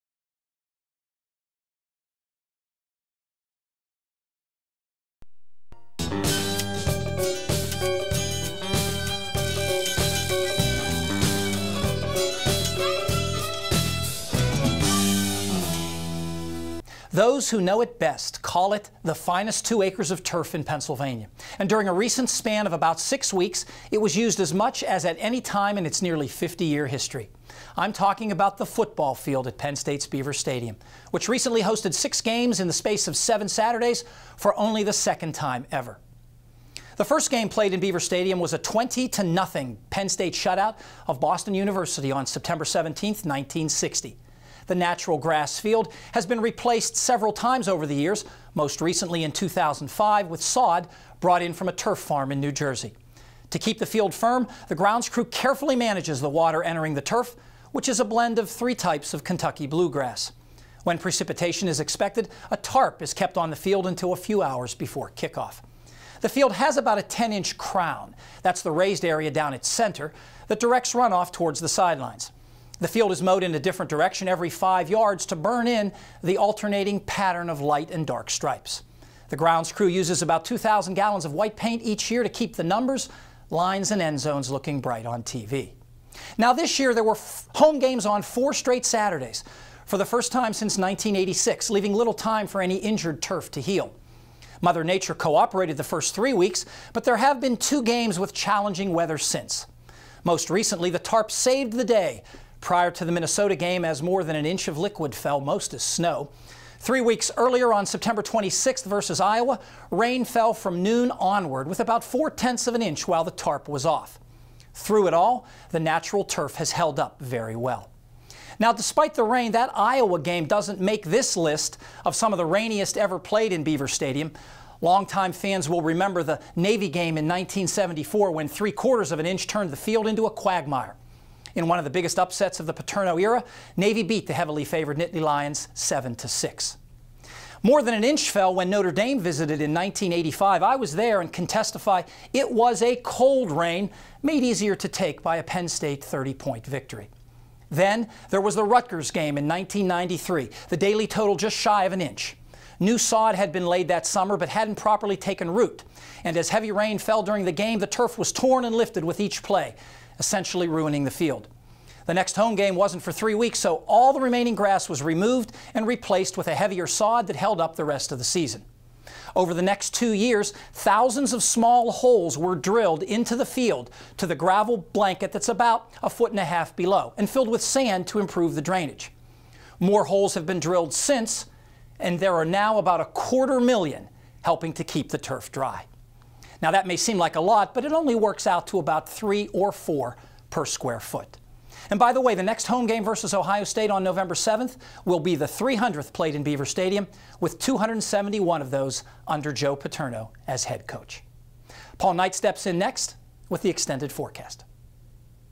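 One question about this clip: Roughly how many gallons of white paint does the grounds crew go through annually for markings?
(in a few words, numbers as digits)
2,000.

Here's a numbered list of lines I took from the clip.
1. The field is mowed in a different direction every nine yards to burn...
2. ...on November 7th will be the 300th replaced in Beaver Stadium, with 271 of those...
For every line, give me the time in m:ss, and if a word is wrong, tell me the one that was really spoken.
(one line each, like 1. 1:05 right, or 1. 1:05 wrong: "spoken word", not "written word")
1. 1:12 wrong: "five", not "nine"
2. 3:13 wrong: "played", not "replaced".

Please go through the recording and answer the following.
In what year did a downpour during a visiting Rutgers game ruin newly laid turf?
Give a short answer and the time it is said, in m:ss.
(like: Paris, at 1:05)
1993, at 2:29.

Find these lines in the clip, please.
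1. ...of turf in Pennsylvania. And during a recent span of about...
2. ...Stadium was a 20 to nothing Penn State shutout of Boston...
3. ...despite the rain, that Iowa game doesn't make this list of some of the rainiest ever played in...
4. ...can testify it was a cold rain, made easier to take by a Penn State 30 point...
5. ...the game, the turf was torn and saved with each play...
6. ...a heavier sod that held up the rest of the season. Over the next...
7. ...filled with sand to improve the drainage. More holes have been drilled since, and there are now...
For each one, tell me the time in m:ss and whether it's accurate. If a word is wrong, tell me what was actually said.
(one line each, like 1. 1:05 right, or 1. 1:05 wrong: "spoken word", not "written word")
1. 0:20 right
2. 0:37 right
3. 1:58 right
4. 2:21 right
5. 2:37 wrong: "lifted", not "saved"
6. 2:46 right
7. 2:57 right.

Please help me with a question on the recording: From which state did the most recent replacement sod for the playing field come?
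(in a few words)
New Jersey.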